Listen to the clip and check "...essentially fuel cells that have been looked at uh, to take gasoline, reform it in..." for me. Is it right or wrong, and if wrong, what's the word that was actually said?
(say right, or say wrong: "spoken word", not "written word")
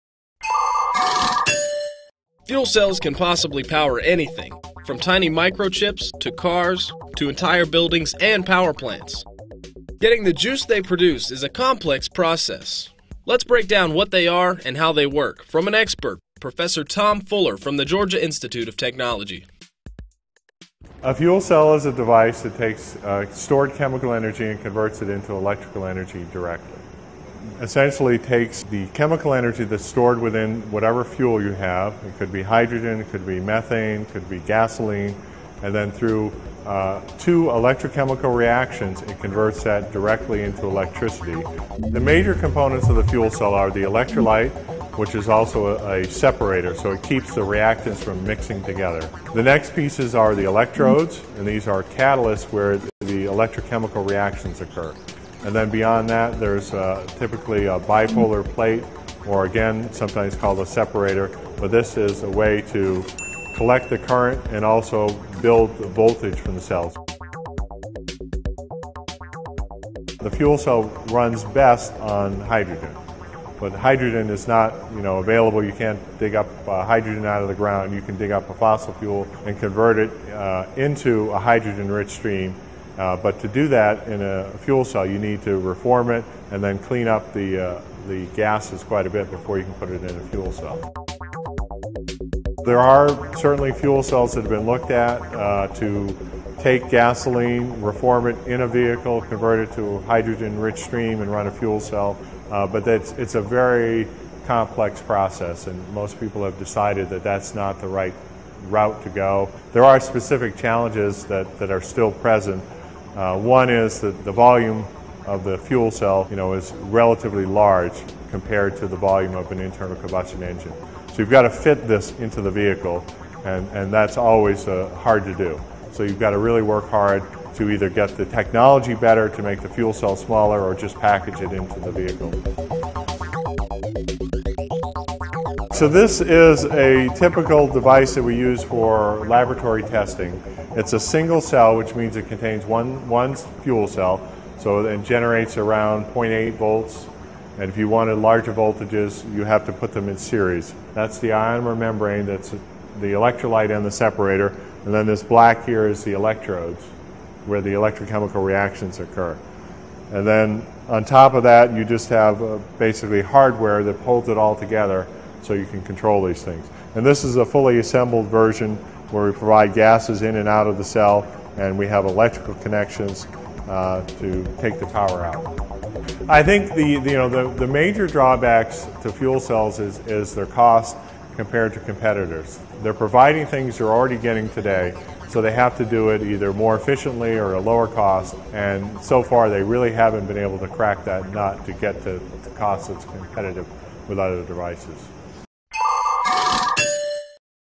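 wrong: "certainly", not "essentially".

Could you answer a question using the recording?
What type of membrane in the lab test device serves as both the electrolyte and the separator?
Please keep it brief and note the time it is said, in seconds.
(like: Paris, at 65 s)
ionomer membrane, at 151 s.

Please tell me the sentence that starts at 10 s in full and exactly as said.
Getting the juice they produce is a complex process.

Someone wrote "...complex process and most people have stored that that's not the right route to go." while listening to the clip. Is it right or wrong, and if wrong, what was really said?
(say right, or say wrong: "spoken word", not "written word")
wrong: "decided", not "stored".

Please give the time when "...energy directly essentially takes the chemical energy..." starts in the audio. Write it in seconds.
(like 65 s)
25 s.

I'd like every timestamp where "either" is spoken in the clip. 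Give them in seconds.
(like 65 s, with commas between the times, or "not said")
127 s, 186 s.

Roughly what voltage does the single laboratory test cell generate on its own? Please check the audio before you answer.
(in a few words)
0.8 volts.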